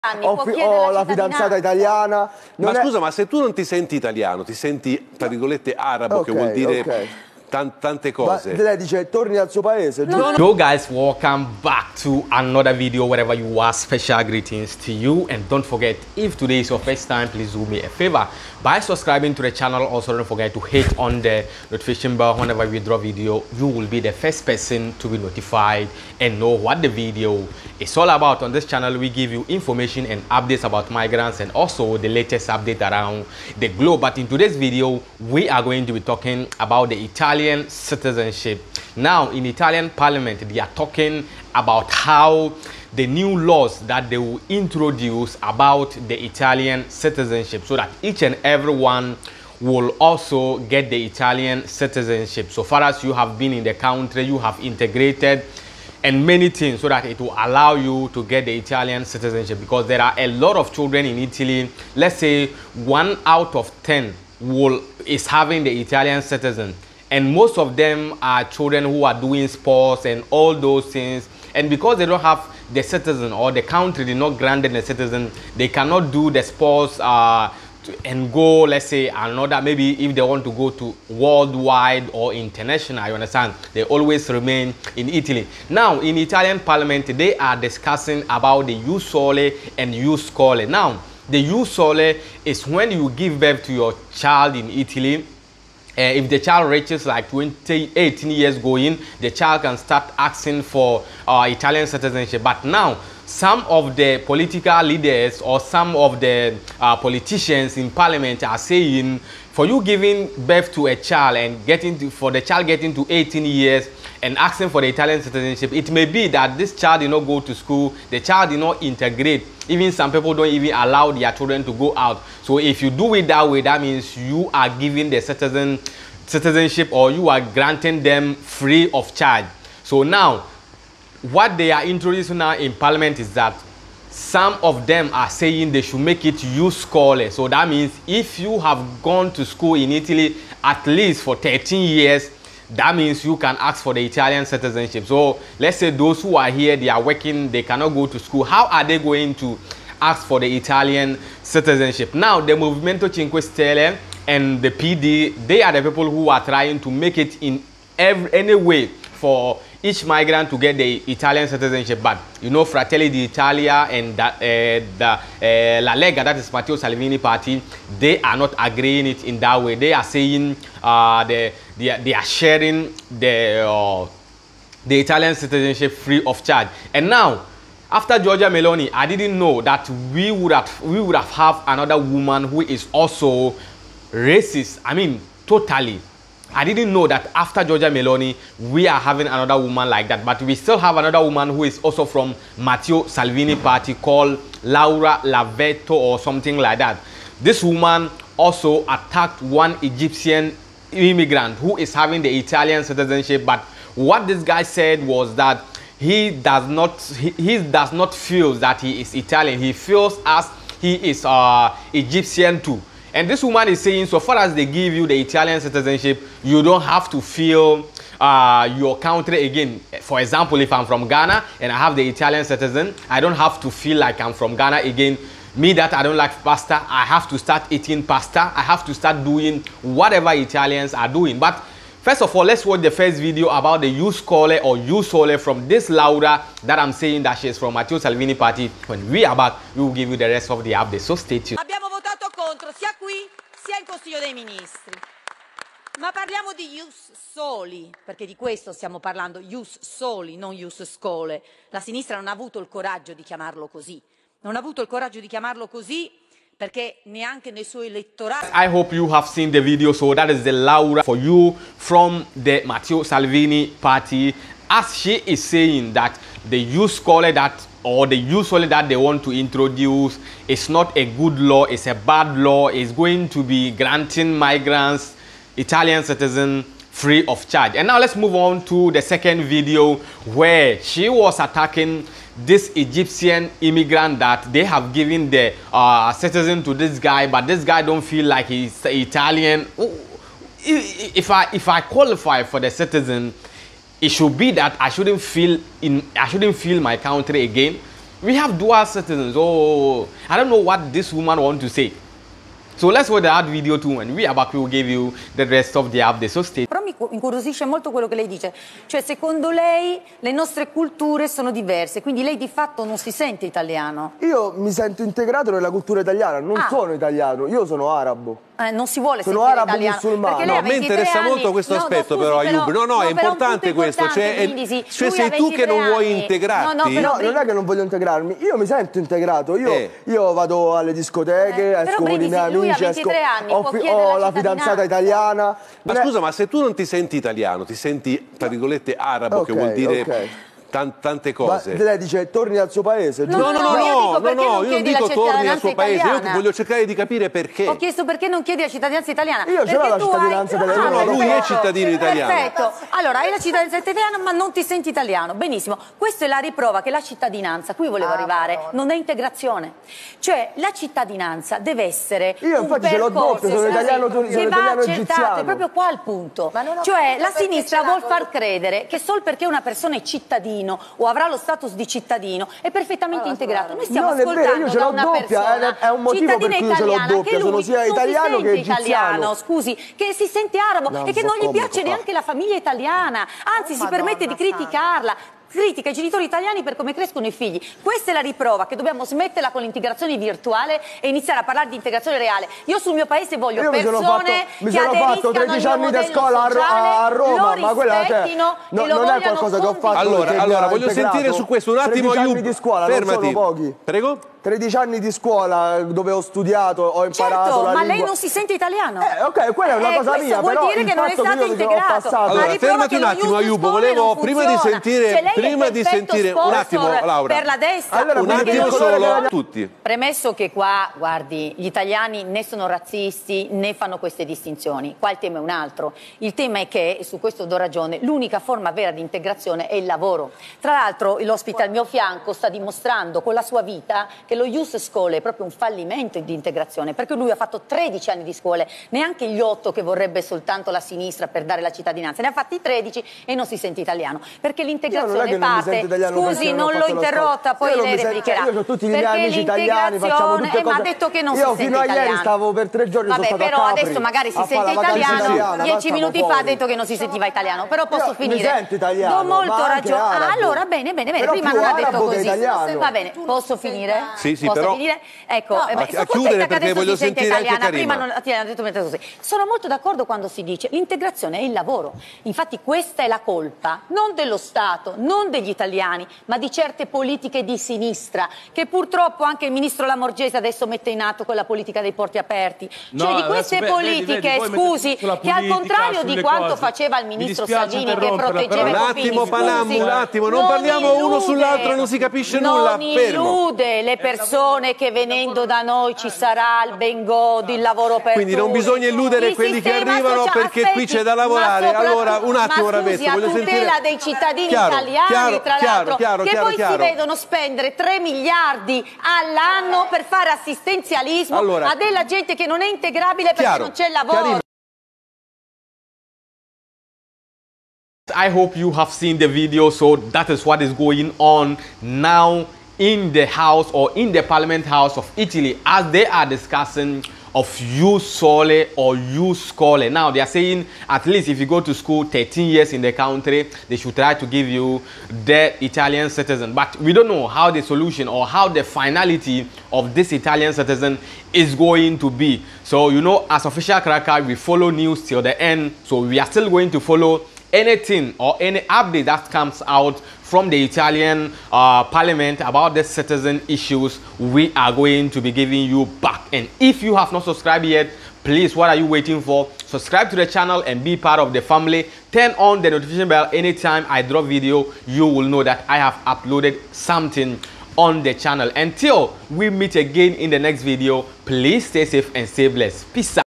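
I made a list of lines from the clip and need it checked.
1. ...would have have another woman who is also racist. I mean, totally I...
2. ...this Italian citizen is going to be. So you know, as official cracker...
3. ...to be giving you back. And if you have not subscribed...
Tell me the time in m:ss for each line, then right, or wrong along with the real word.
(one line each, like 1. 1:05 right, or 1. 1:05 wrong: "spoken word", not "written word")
1. 3:00 right
2. 8:59 right
3. 9:15 right.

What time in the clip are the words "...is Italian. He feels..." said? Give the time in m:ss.
3:28.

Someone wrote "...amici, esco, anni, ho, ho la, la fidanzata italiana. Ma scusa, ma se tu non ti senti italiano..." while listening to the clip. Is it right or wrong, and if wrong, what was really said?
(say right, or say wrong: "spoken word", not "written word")
right.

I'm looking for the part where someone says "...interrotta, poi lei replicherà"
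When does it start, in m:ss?
7:26.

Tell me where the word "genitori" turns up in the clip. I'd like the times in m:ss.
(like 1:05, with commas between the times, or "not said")
6:25.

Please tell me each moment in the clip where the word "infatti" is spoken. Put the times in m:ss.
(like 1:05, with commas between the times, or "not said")
6:02, 7:52.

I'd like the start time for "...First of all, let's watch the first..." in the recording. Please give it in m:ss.
3:52.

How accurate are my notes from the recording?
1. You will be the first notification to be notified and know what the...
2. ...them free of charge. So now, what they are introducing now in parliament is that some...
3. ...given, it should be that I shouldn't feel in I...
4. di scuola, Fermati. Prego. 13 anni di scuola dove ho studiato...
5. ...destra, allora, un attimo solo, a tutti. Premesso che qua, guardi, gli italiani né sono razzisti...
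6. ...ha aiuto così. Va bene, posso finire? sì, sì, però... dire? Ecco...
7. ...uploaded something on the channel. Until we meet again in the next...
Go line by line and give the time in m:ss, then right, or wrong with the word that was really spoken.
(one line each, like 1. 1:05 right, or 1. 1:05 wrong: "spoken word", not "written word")
1. 0:23 wrong: "person", not "notification"
2. 2:08 right
3. 4:52 wrong: "citizen", not "given"
4. 6:42 right
5. 6:57 right
6. 7:41 wrong: "detto", not "aiuto"
7. 9:26 right.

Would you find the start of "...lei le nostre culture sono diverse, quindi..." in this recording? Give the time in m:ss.
5:09.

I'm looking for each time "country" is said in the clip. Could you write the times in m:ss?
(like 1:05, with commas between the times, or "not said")
0:53, 1:13, 3:38, 4:56, 8:52.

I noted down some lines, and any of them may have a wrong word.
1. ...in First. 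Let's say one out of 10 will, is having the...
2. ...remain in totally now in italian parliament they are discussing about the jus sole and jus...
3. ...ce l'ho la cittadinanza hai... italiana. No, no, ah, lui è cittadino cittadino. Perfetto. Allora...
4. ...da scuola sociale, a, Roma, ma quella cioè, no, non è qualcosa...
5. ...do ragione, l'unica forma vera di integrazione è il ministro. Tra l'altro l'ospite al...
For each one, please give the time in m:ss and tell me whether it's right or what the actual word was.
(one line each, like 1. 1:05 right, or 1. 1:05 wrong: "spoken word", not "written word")
1. 1:01 wrong: "Italy", not "First"
2. 1:24 wrong: "italy", not "totally"
3. 5:49 wrong: "italiano", not "cittadino"
4. 6:35 right
5. 7:07 wrong: "lavoro", not "ministro".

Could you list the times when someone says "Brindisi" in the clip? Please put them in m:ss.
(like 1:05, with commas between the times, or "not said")
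5:24.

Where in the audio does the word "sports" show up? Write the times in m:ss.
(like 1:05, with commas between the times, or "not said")
1:09, 1:16.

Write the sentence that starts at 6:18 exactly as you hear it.
Italiano, scusi, che si sente arabo no, e che non gli piace ah.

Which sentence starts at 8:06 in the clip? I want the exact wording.
faceva il ministro Salvini che proteggeva i bambini.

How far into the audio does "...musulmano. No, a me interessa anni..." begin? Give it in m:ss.
5:19.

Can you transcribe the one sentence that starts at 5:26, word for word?
No, però, non è che non voglio integrarmi, io mi sento integrato.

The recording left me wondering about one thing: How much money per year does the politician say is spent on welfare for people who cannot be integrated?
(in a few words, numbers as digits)
3 billion.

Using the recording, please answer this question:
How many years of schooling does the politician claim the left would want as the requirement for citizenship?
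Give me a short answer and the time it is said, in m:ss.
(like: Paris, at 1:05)
8, at 7:19.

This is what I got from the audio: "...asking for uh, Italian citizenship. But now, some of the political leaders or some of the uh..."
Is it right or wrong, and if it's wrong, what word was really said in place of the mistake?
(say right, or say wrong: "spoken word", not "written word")
right.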